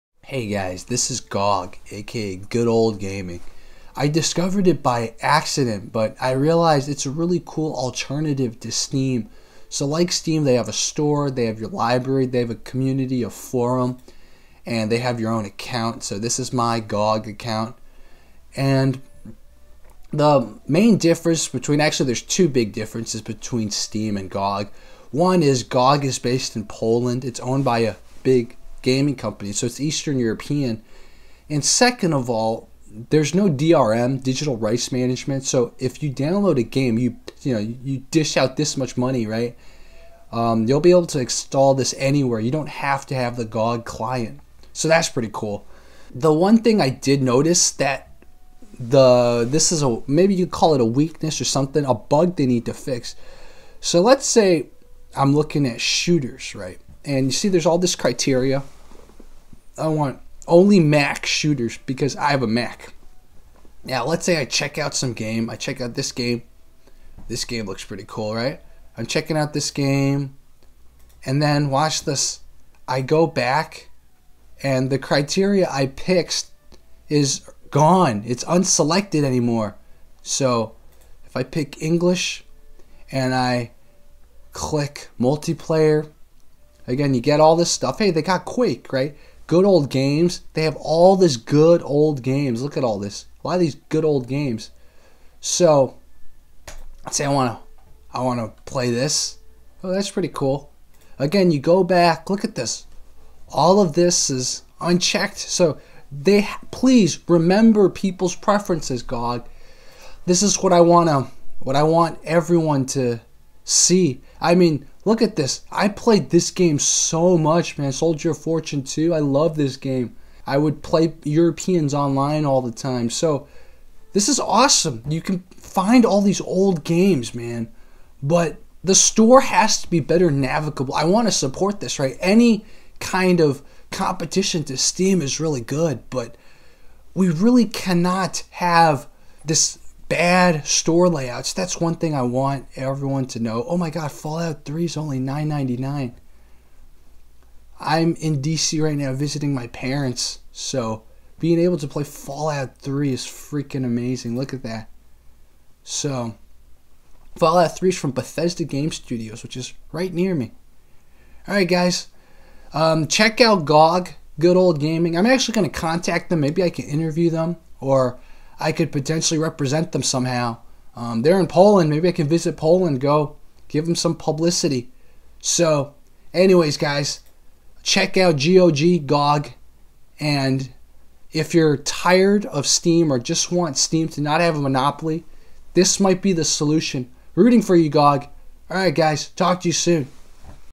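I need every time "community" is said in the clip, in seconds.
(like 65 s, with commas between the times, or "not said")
12 s.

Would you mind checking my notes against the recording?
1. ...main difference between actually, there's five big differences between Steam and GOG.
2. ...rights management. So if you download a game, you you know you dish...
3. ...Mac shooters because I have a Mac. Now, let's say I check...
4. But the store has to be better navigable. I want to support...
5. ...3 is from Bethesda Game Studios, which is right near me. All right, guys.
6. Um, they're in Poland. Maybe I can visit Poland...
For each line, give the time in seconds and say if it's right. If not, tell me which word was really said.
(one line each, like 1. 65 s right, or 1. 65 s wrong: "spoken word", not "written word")
1. 20 s wrong: "two", not "five"
2. 34 s right
3. 60 s right
4. 128 s right
5. 157 s right
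6. 170 s right.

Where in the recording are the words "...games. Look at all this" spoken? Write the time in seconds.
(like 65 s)
92 s.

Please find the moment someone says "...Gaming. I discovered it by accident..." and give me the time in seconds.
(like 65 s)
2 s.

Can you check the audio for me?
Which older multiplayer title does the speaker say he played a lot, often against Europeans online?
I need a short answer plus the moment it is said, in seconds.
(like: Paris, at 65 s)
Soldier of Fortune 2, at 117 s.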